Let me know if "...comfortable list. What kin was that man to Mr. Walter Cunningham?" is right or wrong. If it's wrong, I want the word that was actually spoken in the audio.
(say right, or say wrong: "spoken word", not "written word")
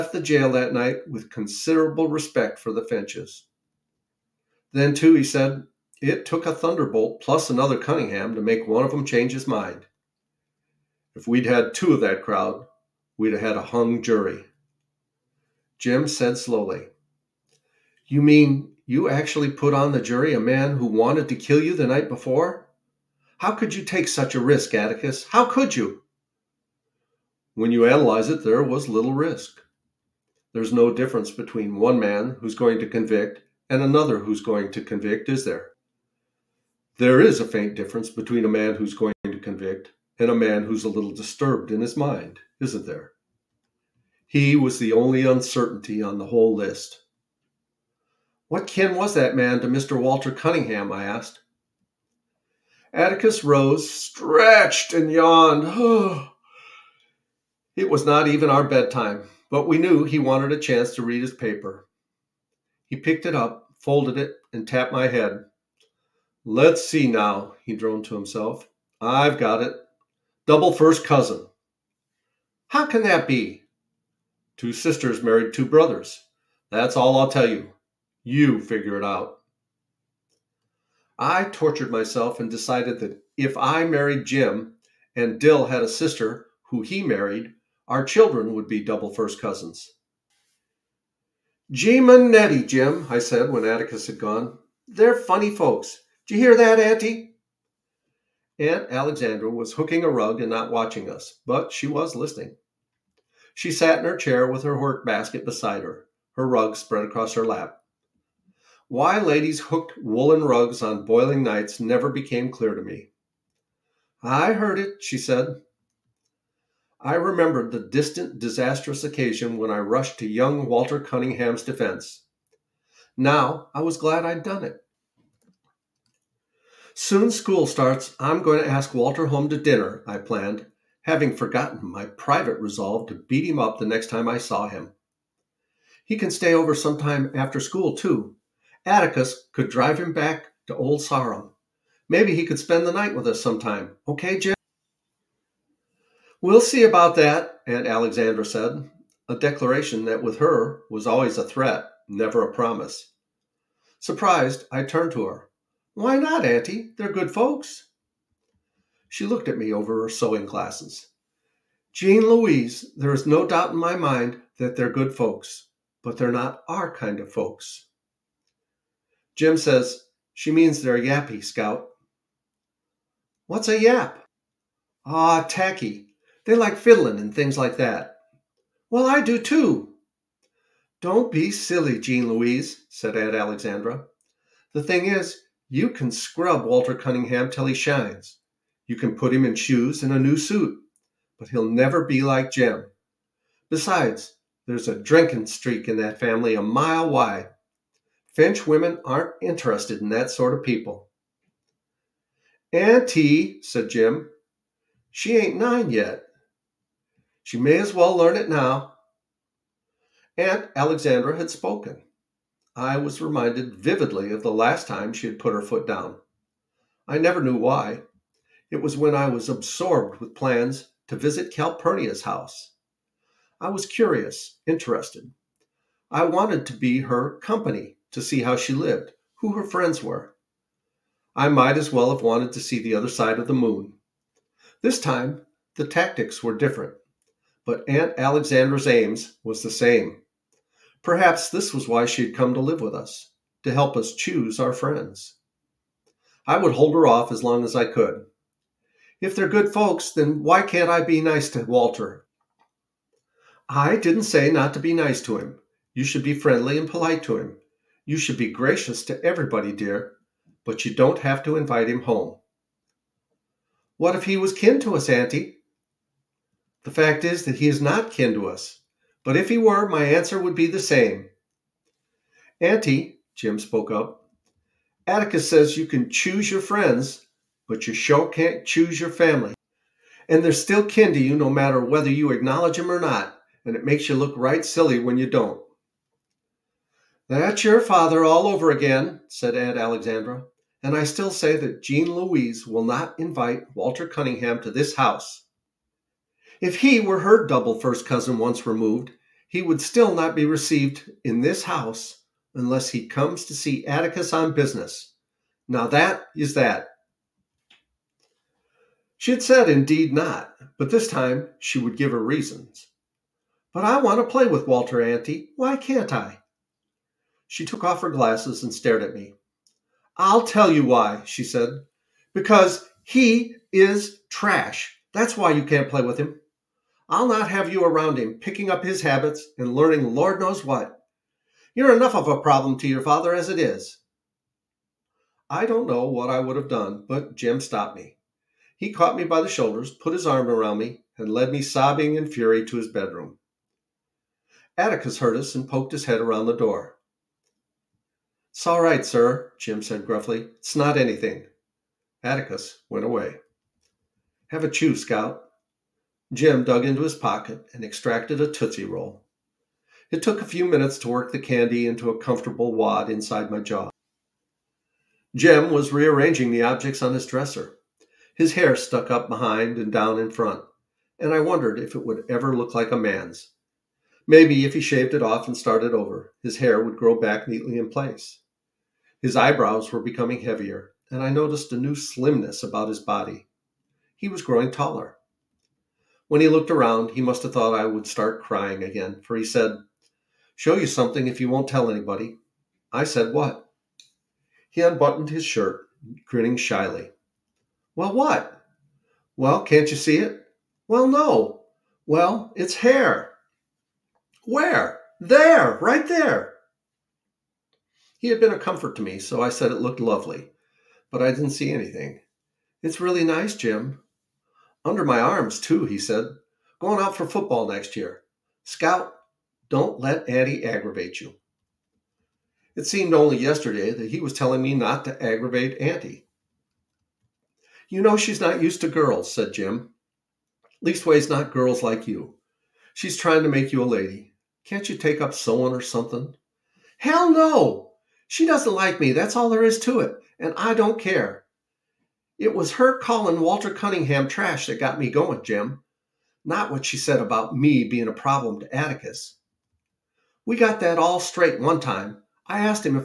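wrong: "whole", not "comfortable".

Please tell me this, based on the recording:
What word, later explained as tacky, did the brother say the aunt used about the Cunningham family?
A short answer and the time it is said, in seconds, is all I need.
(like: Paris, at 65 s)
Yappy, at 170 s.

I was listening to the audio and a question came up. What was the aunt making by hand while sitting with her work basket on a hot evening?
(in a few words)
A rug.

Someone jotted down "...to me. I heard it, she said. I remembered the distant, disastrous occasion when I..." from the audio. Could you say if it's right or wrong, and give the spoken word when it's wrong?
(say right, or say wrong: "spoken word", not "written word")
right.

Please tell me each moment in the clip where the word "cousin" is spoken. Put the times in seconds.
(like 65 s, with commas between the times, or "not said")
71 s, 89 s, 298 s.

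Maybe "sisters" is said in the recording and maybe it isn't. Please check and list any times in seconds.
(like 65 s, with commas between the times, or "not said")
74 s, 85 s.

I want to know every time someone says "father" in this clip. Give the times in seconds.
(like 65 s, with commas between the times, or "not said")
287 s, 333 s.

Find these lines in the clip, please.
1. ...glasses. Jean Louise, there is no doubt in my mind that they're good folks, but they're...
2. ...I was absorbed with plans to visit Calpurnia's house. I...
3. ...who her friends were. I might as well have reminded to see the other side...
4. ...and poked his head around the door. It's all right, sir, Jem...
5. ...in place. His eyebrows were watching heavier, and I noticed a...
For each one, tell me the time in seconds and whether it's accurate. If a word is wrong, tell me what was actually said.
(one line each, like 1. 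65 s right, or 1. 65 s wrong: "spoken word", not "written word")
1. 160 s right
2. 219 s right
3. 229 s wrong: "wanted", not "reminded"
4. 345 s right
5. 377 s wrong: "becoming", not "watching".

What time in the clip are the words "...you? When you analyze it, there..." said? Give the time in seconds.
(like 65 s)
25 s.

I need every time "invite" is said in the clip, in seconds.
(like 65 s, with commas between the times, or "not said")
261 s, 293 s.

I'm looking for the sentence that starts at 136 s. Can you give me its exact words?
He can stay over sometime after school, too.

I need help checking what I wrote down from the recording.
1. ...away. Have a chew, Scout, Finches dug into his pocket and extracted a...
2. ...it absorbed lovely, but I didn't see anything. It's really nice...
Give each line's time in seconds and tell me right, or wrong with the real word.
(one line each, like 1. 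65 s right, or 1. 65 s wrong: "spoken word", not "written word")
1. 353 s wrong: "Jem", not "Finches"
2. 409 s wrong: "looked", not "absorbed".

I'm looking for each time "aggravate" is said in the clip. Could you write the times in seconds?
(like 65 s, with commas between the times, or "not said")
420 s, 425 s.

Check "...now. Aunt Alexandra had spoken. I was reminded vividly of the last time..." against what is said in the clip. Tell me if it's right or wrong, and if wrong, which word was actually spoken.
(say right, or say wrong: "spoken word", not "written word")
right.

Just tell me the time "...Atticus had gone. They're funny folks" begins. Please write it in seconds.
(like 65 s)
93 s.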